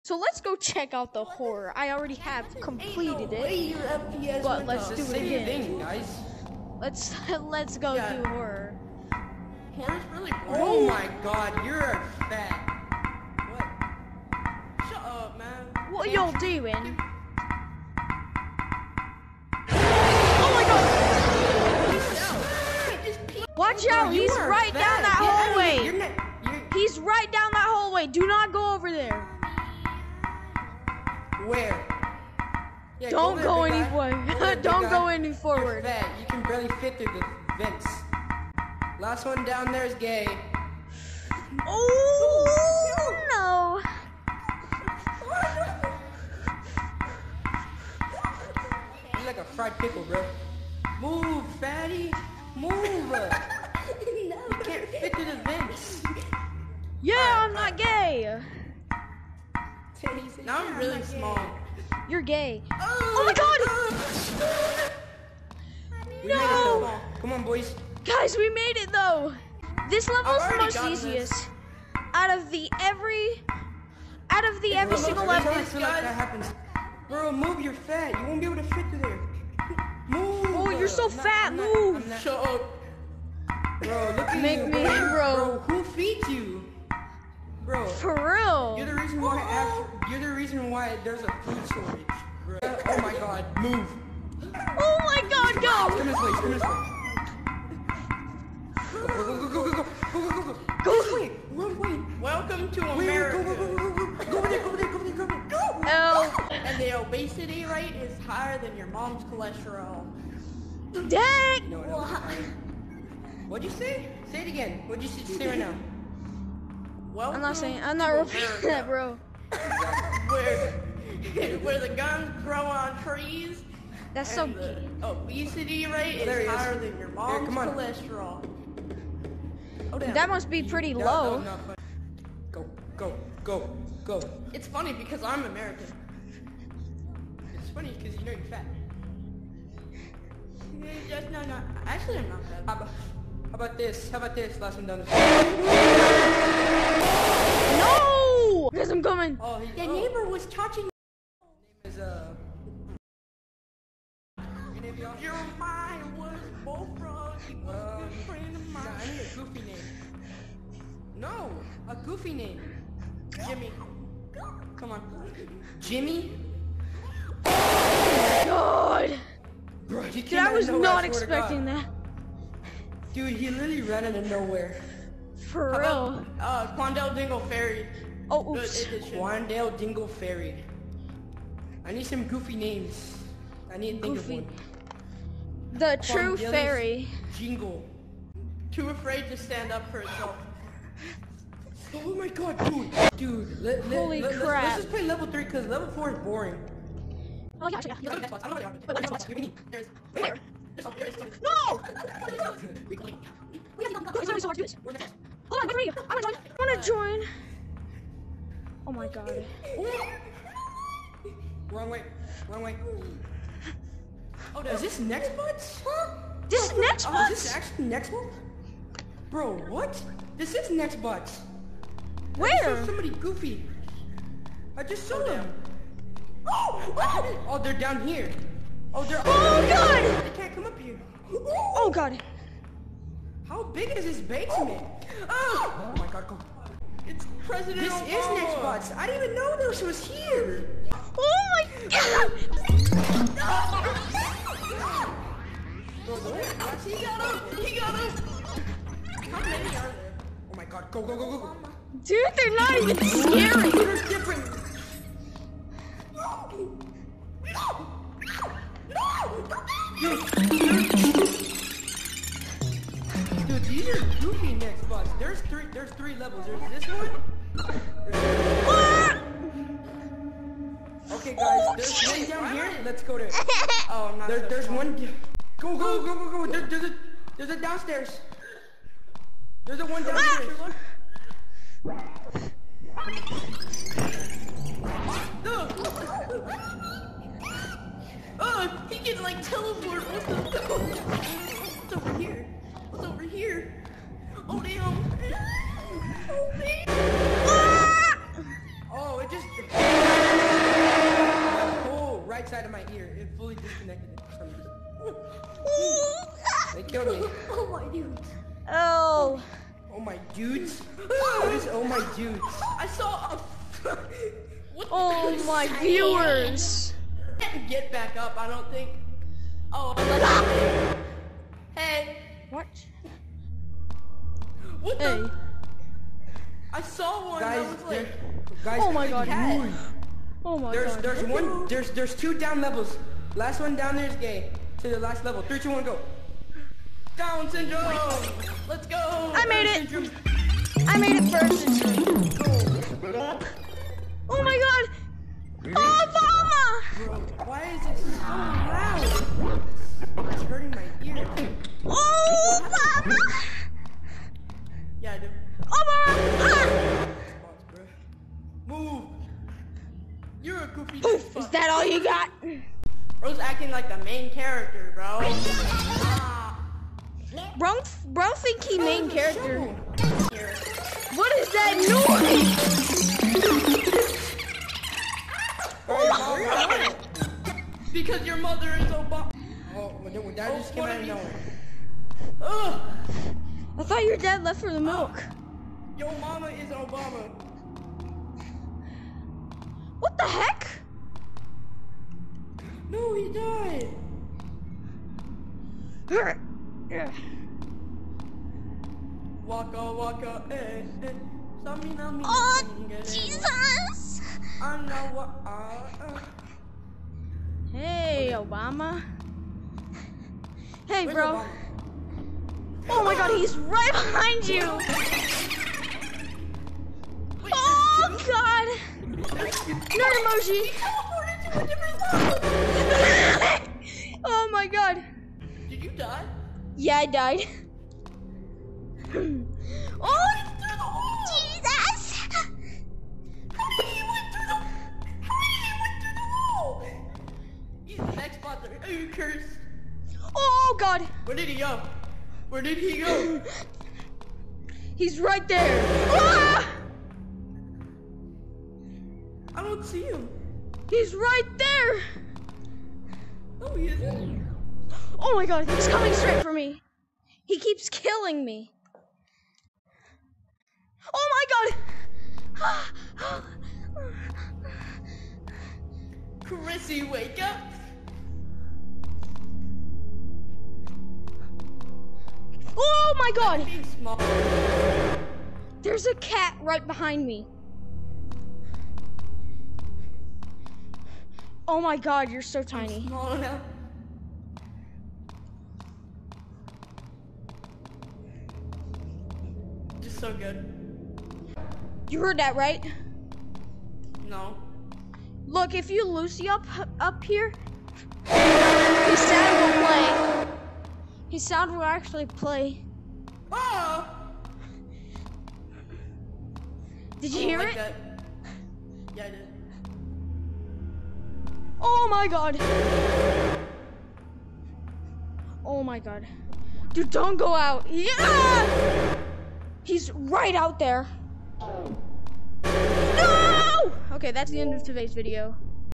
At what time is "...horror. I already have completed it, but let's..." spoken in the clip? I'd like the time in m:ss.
0:01.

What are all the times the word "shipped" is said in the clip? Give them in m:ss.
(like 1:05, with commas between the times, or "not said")
not said.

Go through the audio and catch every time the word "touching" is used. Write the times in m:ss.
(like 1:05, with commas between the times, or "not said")
2:30.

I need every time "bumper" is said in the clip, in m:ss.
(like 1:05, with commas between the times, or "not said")
not said.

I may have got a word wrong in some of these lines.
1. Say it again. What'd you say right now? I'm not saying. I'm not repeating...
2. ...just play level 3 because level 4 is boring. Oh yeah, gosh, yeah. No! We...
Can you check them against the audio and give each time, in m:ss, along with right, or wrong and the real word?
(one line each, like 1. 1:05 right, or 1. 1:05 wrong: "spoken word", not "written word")
1. 1:54 right
2. 3:14 right.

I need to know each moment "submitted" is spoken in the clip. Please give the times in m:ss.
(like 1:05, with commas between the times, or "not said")
not said.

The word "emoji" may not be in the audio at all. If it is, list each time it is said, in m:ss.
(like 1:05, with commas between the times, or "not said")
7:00.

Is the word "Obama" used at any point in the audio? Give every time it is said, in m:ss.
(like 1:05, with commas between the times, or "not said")
3:57, 6:18, 6:26, 6:48.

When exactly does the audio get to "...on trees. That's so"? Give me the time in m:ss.
2:02.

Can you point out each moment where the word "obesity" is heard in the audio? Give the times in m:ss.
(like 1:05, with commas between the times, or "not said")
1:46, 2:05.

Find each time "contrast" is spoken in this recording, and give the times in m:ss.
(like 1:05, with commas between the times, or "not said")
not said.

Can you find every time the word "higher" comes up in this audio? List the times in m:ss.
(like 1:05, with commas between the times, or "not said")
1:48, 2:06.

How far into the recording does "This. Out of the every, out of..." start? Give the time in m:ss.
1:11.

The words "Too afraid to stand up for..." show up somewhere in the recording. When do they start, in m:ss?
3:08.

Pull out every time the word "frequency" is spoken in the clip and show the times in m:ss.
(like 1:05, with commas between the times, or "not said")
not said.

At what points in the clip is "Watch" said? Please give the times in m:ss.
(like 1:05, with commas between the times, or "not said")
0:23, 5:22.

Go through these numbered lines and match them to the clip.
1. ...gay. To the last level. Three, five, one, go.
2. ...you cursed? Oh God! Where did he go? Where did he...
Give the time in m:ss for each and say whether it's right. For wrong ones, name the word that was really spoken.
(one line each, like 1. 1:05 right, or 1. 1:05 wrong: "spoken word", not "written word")
1. 5:34 wrong: "two", not "five"
2. 7:18 right.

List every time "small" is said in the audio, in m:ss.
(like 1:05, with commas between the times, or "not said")
1:01.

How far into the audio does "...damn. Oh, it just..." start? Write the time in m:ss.
4:56.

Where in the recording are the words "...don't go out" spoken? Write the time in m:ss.
8:37.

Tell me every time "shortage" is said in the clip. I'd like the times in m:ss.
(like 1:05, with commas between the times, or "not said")
1:31.